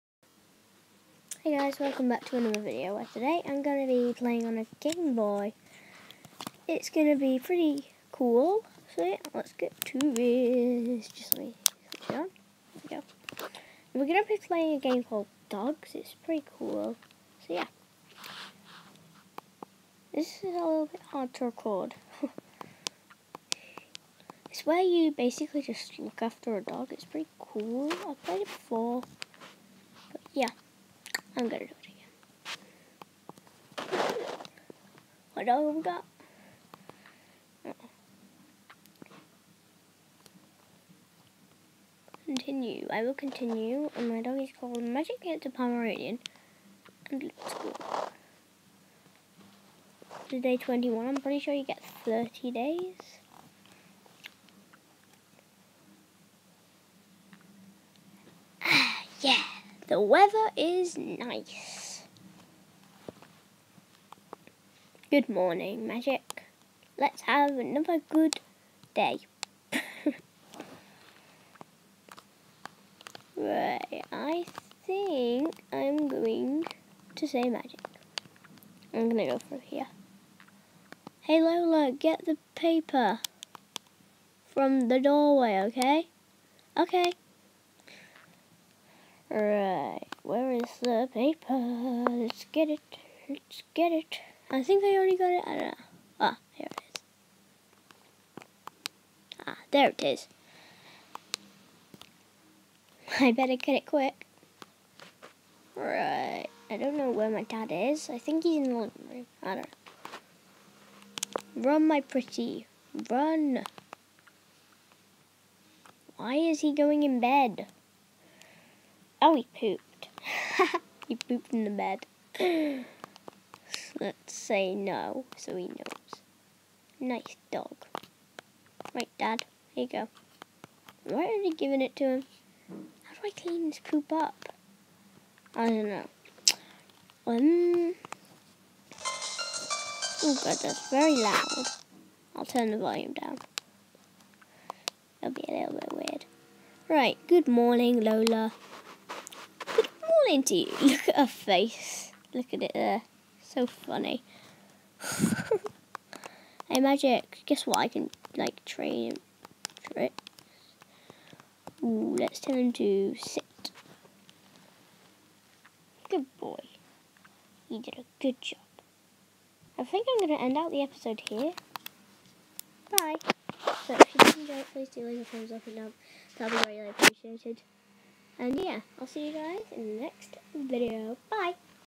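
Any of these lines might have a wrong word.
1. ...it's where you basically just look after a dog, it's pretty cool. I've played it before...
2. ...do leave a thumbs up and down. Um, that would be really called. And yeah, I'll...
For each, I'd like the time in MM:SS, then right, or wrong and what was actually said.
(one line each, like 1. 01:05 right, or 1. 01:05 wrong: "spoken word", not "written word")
1. 00:24 right
2. 02:54 wrong: "appreciated", not "called".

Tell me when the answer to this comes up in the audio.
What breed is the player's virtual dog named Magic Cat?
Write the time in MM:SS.
00:45.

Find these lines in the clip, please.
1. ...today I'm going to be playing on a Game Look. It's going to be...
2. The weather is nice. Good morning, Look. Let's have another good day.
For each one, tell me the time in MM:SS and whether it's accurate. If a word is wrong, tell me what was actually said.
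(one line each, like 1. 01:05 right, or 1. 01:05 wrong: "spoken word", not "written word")
1. 00:03 wrong: "Boy", not "Look"
2. 00:59 wrong: "Magic", not "Look".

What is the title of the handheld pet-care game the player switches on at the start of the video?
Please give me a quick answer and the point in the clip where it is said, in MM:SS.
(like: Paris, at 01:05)
Dogz, at 00:15.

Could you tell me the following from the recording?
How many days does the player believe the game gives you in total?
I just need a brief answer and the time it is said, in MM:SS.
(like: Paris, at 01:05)
30, at 00:52.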